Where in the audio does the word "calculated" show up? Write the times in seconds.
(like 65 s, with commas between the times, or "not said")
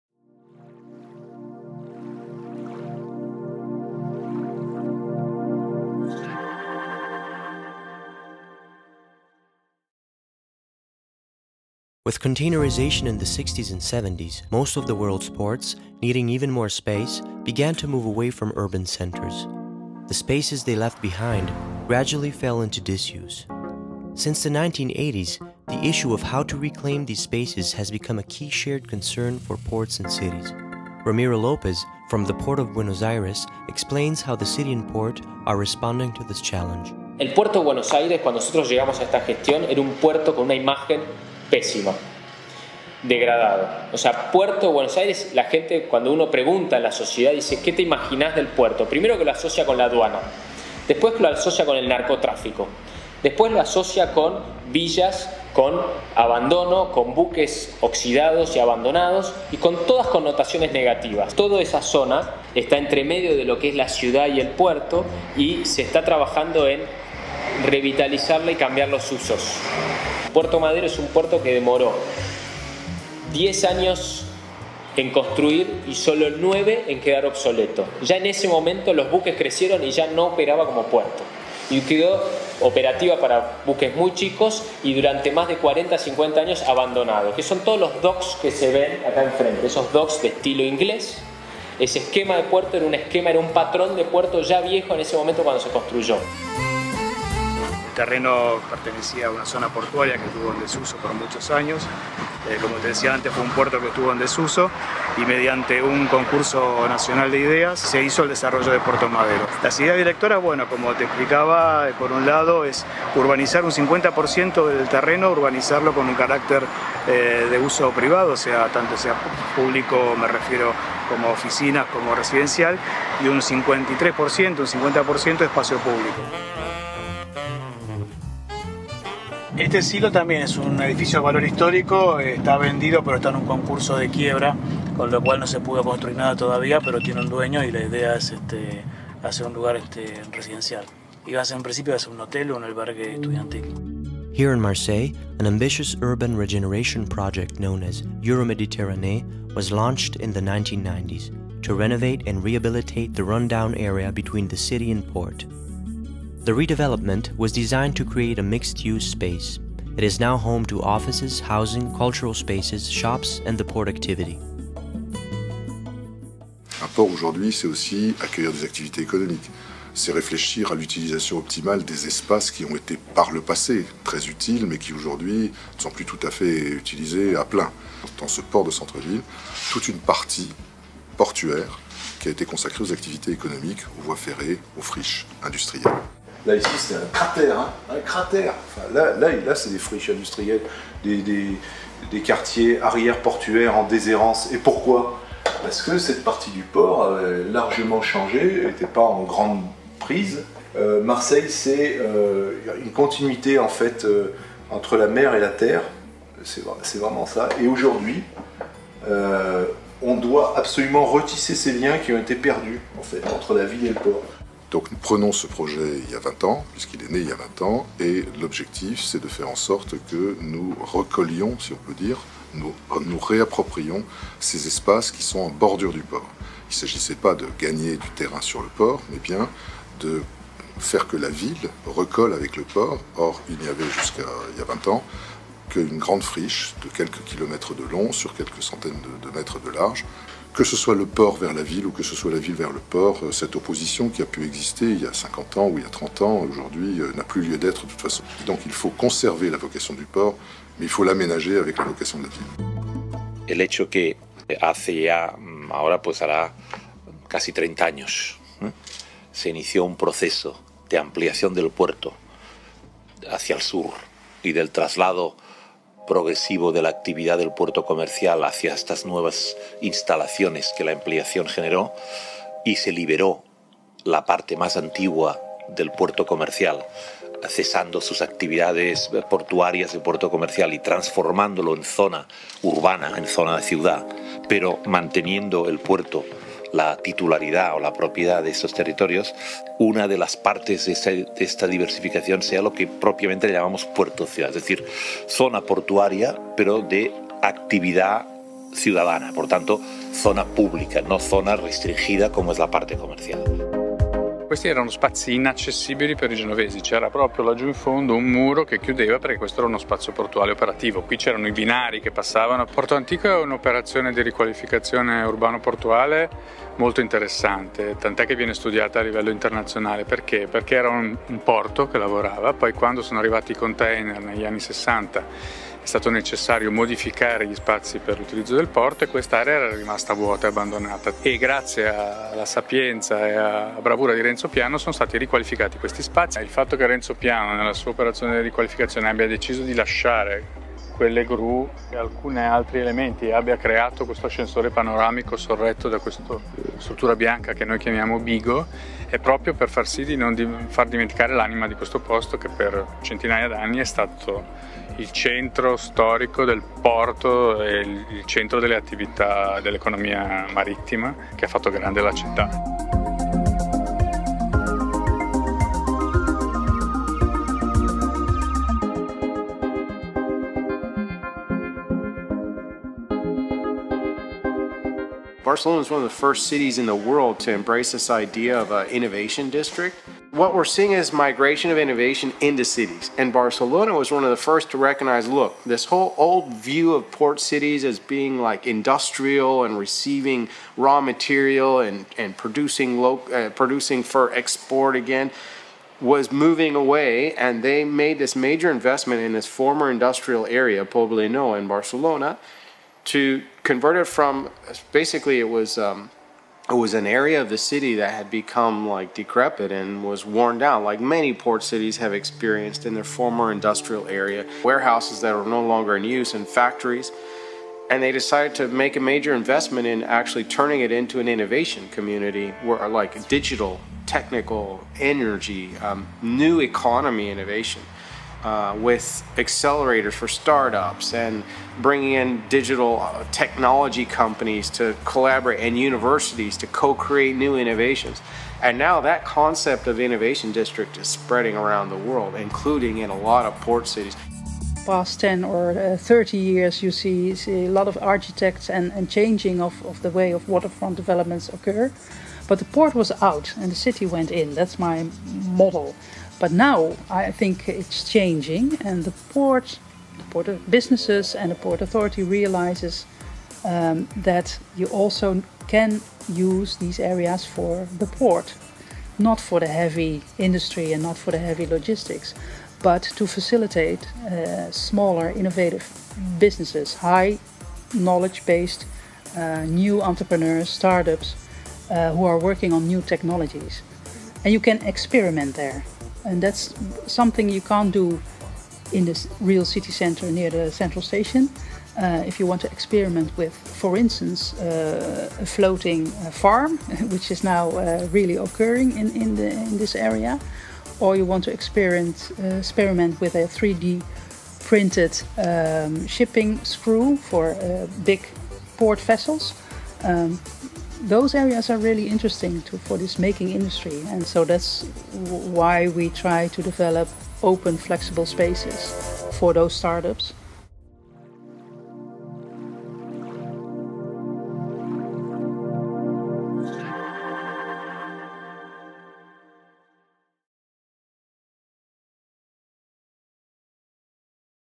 not said.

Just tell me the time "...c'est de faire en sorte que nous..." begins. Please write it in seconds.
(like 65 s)
219 s.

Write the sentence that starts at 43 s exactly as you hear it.
O sea, Puerto Buenos Aires, la gente cuando uno pregunta a la sociedad dice, ¿qué te imaginas del puerto?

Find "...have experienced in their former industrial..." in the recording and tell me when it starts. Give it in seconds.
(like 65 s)
411 s.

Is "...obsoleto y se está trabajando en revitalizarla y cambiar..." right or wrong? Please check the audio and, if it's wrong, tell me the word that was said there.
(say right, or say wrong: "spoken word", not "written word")
wrong: "puerto", not "obsoleto".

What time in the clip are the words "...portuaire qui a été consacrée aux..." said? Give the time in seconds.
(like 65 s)
181 s.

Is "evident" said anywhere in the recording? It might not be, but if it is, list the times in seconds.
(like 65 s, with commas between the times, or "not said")
not said.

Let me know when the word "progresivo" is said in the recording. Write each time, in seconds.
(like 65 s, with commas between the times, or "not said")
266 s.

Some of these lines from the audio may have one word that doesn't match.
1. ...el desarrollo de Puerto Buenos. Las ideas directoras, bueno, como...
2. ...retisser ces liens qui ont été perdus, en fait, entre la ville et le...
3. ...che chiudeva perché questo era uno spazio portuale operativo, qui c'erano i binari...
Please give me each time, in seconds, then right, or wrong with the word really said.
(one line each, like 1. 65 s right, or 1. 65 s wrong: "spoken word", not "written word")
1. 108 s wrong: "Madero", not "Buenos"
2. 211 s right
3. 308 s right.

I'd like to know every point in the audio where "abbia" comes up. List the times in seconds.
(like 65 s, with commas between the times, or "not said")
339 s, 343 s.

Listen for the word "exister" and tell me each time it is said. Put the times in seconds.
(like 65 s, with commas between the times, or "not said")
244 s.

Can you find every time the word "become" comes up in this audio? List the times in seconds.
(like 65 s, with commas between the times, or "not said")
27 s, 408 s.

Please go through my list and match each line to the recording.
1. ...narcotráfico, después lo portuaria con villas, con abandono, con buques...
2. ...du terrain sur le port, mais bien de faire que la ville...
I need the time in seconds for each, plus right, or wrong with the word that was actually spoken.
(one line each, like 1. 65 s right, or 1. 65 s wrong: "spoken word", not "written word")
1. 51 s wrong: "asocia", not "portuaria"
2. 227 s right.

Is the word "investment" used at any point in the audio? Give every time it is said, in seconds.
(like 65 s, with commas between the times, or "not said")
398 s, 419 s.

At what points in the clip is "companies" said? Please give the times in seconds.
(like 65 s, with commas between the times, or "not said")
434 s.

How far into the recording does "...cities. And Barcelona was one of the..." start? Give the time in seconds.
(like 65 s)
382 s.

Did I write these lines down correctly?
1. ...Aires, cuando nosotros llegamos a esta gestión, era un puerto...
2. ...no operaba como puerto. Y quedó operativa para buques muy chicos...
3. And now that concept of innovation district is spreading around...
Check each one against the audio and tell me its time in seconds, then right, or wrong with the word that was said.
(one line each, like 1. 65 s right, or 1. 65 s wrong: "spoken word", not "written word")
1. 37 s right
2. 80 s right
3. 438 s right.